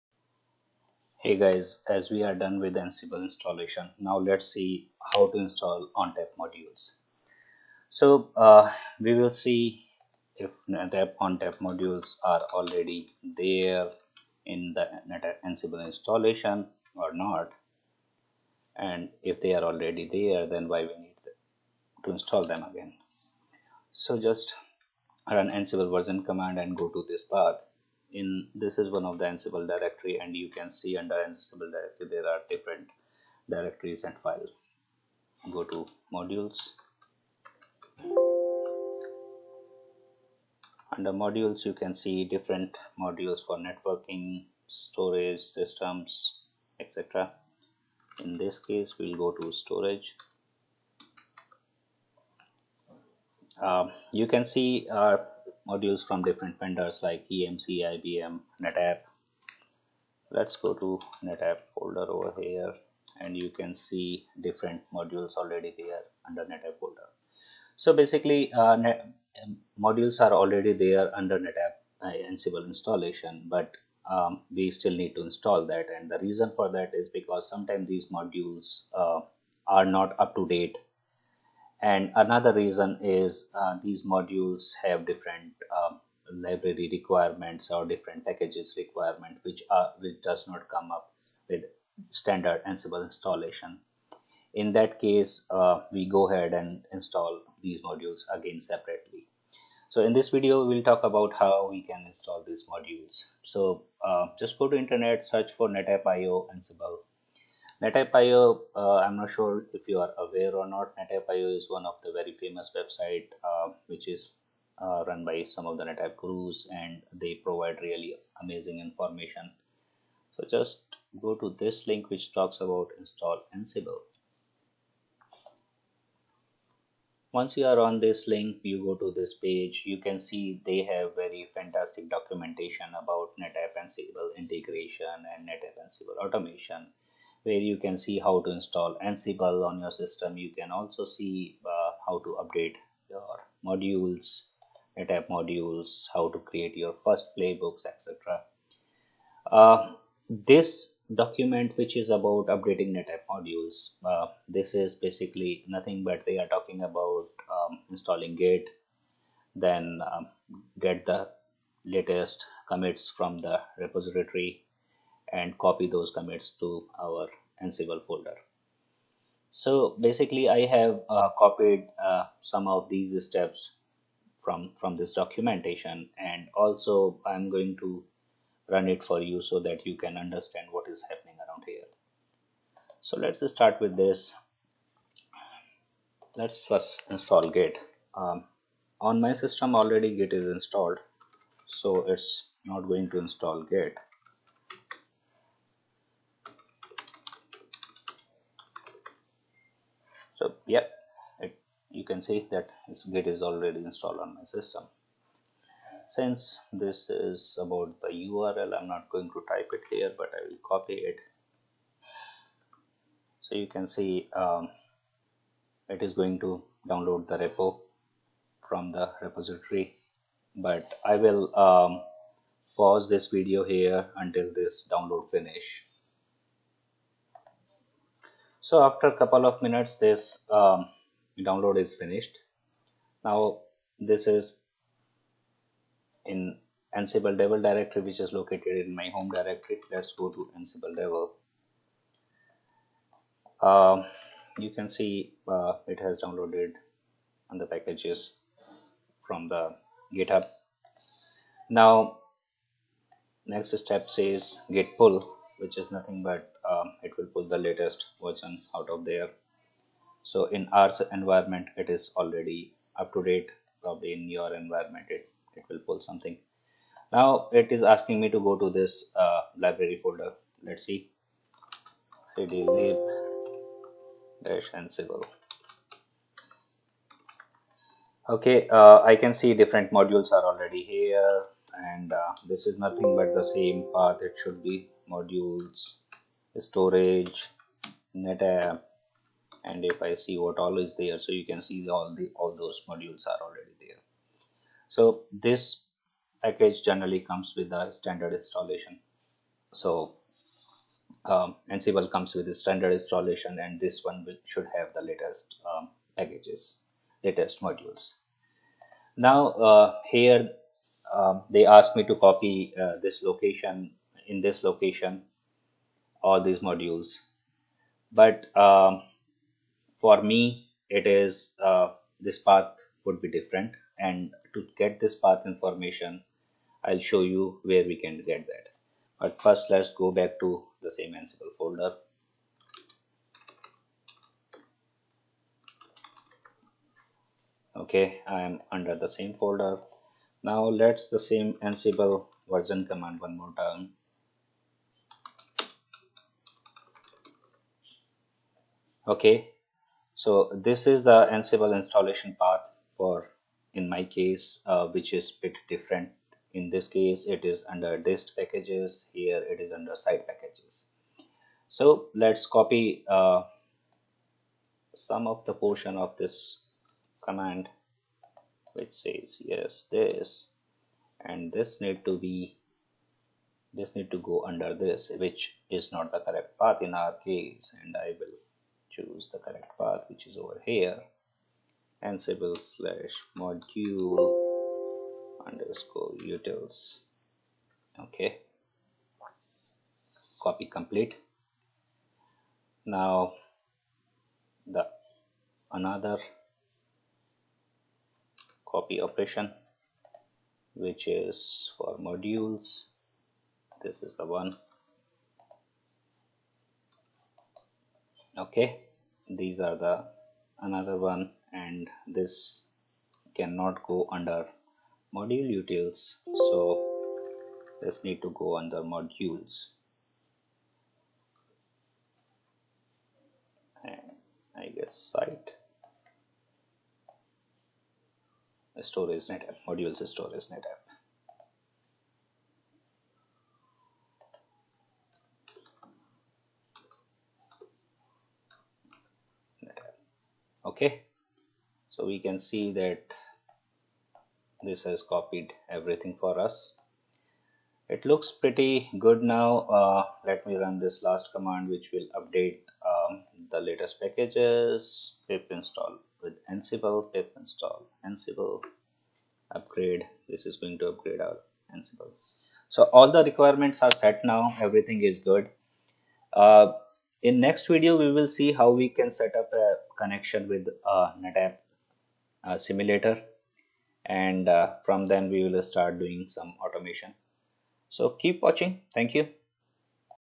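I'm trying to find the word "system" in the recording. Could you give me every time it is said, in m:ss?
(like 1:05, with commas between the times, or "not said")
0:45, 2:19, 3:09, 3:24.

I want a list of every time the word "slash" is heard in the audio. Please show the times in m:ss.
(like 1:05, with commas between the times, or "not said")
6:22.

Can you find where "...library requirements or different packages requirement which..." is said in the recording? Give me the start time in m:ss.
1:26.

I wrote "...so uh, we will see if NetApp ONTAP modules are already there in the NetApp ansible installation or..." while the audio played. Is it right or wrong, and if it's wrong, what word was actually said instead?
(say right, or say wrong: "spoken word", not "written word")
right.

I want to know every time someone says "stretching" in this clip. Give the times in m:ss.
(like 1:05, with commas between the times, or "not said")
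not said.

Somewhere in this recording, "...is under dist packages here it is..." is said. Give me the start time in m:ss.
5:57.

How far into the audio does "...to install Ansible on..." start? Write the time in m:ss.
2:18.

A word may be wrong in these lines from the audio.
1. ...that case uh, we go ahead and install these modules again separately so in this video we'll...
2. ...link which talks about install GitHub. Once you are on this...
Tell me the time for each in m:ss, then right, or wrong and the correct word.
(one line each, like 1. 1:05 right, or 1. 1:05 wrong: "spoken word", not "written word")
1. 1:34 right
2. 2:01 wrong: "Ansible", not "GitHub".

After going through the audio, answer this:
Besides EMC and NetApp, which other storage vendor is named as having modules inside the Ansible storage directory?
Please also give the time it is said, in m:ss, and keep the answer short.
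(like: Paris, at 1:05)
IBM, at 0:57.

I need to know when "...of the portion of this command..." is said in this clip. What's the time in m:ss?
6:05.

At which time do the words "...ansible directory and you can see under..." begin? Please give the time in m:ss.
0:29.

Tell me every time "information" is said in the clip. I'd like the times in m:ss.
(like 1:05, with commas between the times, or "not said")
1:58, 5:25.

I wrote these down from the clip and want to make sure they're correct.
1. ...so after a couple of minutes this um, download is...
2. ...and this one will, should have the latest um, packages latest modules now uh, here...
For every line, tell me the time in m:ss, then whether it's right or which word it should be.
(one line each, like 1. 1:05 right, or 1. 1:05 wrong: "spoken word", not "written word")
1. 3:48 right
2. 5:03 right.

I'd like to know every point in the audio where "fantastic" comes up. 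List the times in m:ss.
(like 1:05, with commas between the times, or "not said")
2:11.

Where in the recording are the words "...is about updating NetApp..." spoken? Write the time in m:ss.
2:31.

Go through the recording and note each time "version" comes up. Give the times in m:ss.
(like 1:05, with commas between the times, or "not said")
0:25, 4:18, 5:42.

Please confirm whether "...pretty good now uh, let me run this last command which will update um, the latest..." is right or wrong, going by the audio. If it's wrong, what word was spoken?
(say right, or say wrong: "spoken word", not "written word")
right.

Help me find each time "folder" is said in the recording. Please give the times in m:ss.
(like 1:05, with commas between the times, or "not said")
1:01, 1:06, 2:48, 4:30, 5:31, 5:39.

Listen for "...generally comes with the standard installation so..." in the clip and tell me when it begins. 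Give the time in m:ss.
4:56.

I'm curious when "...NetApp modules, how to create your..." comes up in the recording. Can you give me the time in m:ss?
2:24.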